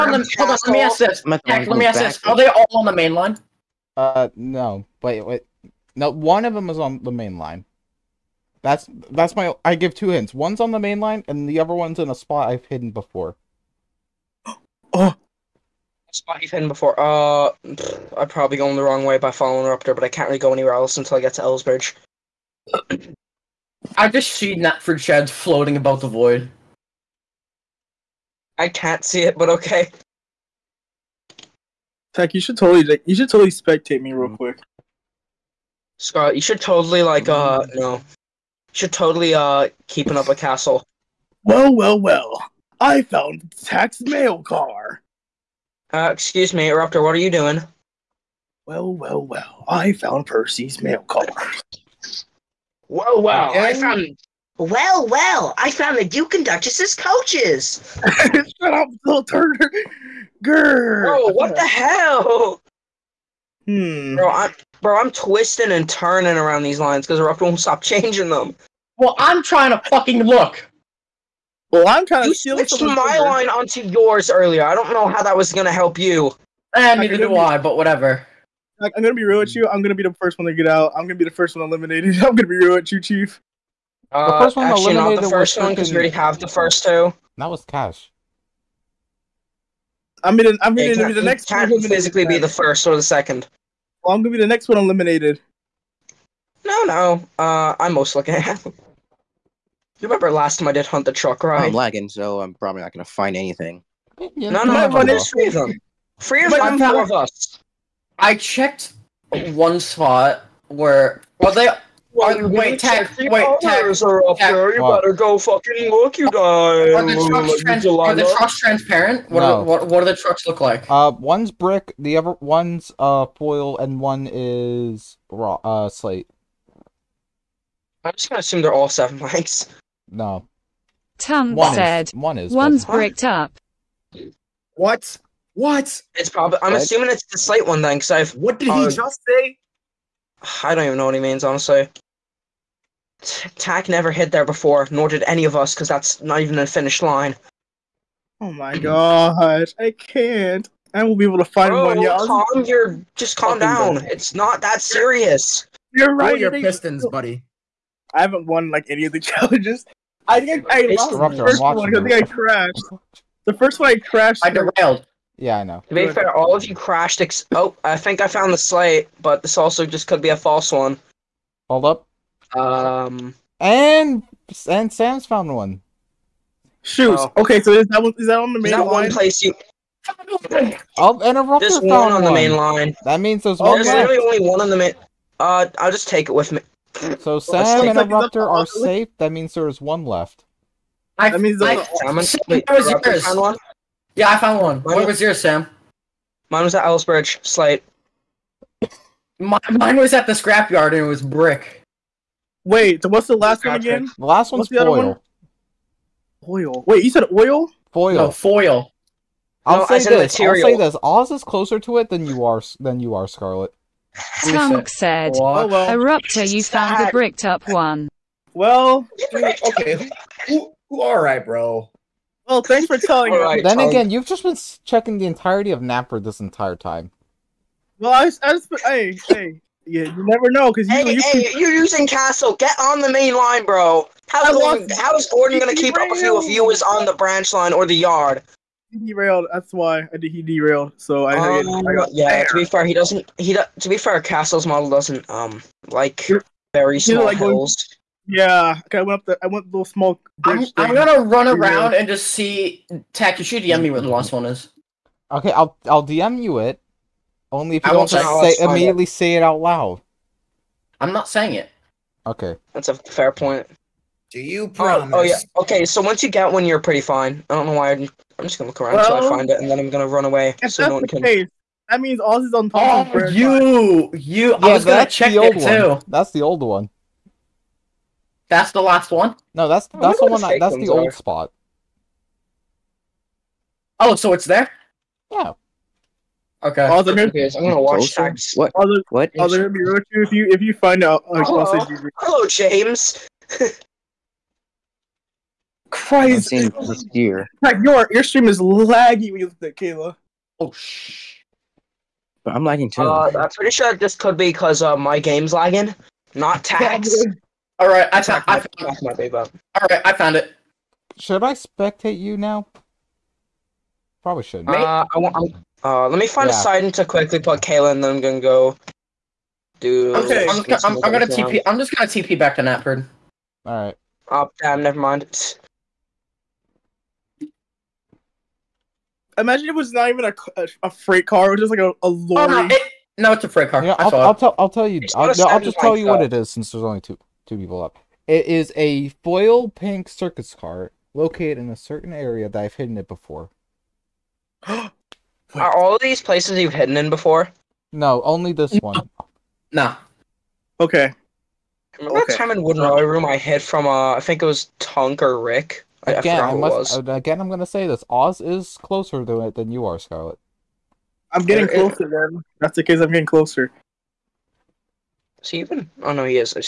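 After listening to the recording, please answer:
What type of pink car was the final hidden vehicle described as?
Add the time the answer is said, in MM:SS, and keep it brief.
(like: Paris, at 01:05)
circus car, at 05:40.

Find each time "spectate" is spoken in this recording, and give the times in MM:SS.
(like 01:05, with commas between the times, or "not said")
00:33, 05:11.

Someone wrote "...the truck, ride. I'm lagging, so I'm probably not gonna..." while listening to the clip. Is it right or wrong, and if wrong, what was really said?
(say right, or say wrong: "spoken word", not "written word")
right.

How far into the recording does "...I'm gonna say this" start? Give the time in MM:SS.
05:57.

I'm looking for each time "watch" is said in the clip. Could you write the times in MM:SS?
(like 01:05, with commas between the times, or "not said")
04:47.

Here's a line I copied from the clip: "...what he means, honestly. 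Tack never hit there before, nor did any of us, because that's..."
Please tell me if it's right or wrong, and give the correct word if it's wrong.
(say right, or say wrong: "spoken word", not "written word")
right.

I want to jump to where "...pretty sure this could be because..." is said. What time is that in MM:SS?
05:03.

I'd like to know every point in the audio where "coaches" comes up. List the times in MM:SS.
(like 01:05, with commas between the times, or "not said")
00:56.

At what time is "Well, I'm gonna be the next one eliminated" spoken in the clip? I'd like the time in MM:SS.
01:34.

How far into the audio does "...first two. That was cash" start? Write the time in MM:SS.
01:26.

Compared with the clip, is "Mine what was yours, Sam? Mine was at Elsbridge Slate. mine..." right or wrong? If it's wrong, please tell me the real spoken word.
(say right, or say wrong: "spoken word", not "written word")
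right.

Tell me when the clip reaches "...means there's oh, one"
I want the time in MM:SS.
03:03.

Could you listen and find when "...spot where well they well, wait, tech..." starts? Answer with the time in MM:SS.
01:49.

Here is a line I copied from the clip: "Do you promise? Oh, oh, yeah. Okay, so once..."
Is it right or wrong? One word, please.
right.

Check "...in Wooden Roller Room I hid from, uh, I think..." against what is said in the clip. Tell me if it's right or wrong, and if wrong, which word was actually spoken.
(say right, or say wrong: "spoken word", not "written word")
right.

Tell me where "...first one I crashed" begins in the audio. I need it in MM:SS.
02:43.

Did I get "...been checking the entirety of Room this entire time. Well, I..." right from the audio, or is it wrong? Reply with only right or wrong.
wrong.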